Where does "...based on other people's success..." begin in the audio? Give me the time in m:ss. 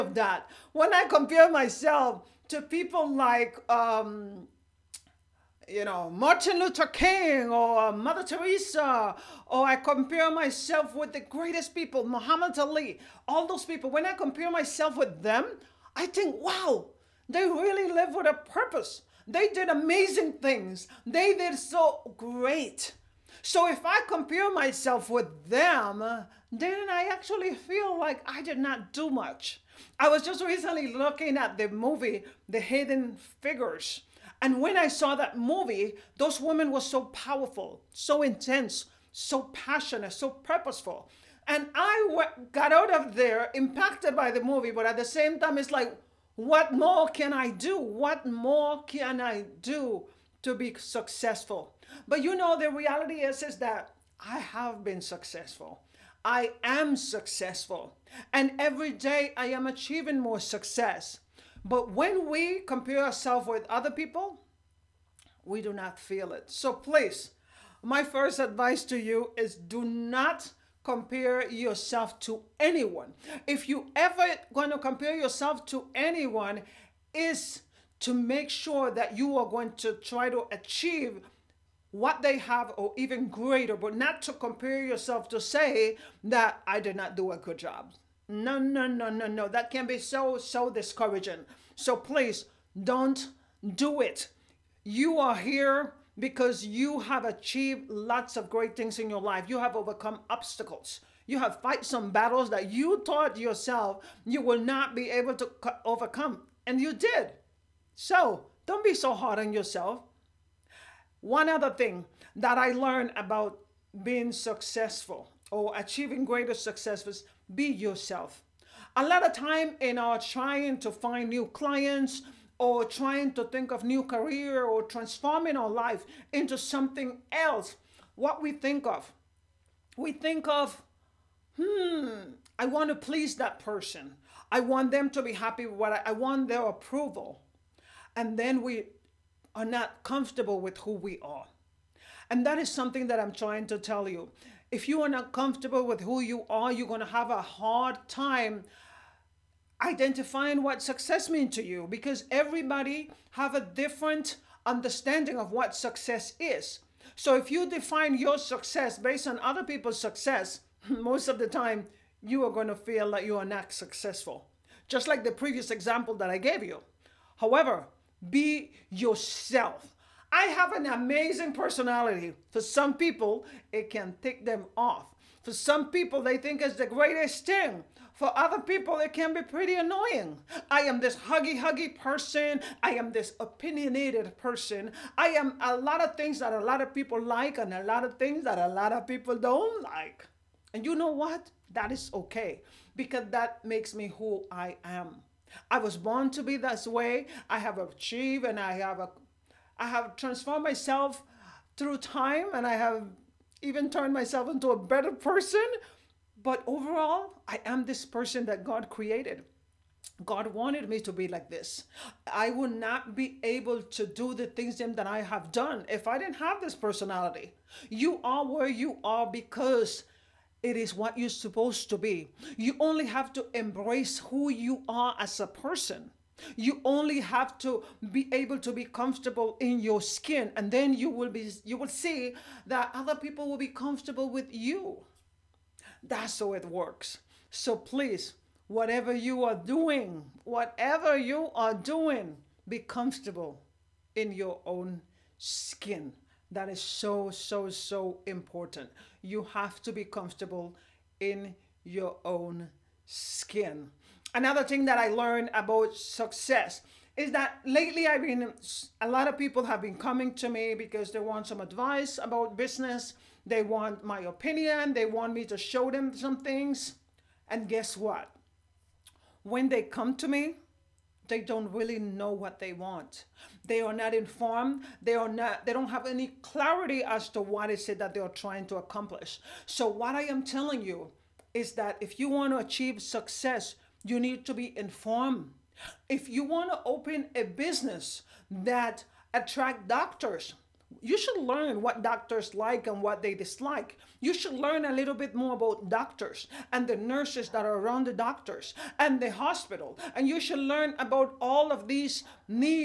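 2:38.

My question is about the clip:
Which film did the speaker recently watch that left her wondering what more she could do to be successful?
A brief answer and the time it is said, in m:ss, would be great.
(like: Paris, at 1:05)
Hidden Figures, at 0:32.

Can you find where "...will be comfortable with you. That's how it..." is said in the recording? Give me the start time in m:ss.
3:53.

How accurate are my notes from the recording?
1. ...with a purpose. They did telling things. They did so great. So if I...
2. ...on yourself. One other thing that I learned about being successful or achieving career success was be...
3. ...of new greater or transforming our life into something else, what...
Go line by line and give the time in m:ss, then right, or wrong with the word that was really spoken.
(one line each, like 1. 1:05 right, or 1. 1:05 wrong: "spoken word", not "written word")
1. 0:18 wrong: "amazing", not "telling"
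2. 1:49 wrong: "greater", not "career"
3. 2:03 wrong: "career", not "greater".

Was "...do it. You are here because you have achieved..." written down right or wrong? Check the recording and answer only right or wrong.
right.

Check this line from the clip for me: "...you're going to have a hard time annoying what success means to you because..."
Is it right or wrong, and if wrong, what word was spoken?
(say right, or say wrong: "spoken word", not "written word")
wrong: "identifying", not "annoying".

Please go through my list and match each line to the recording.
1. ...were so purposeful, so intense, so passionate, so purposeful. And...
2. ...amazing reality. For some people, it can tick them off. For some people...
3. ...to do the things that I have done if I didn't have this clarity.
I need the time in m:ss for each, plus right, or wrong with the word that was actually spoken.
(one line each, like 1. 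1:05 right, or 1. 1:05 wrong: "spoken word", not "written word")
1. 0:36 wrong: "powerful", not "purposeful"
2. 2:50 wrong: "personality", not "reality"
3. 3:33 wrong: "personality", not "clarity".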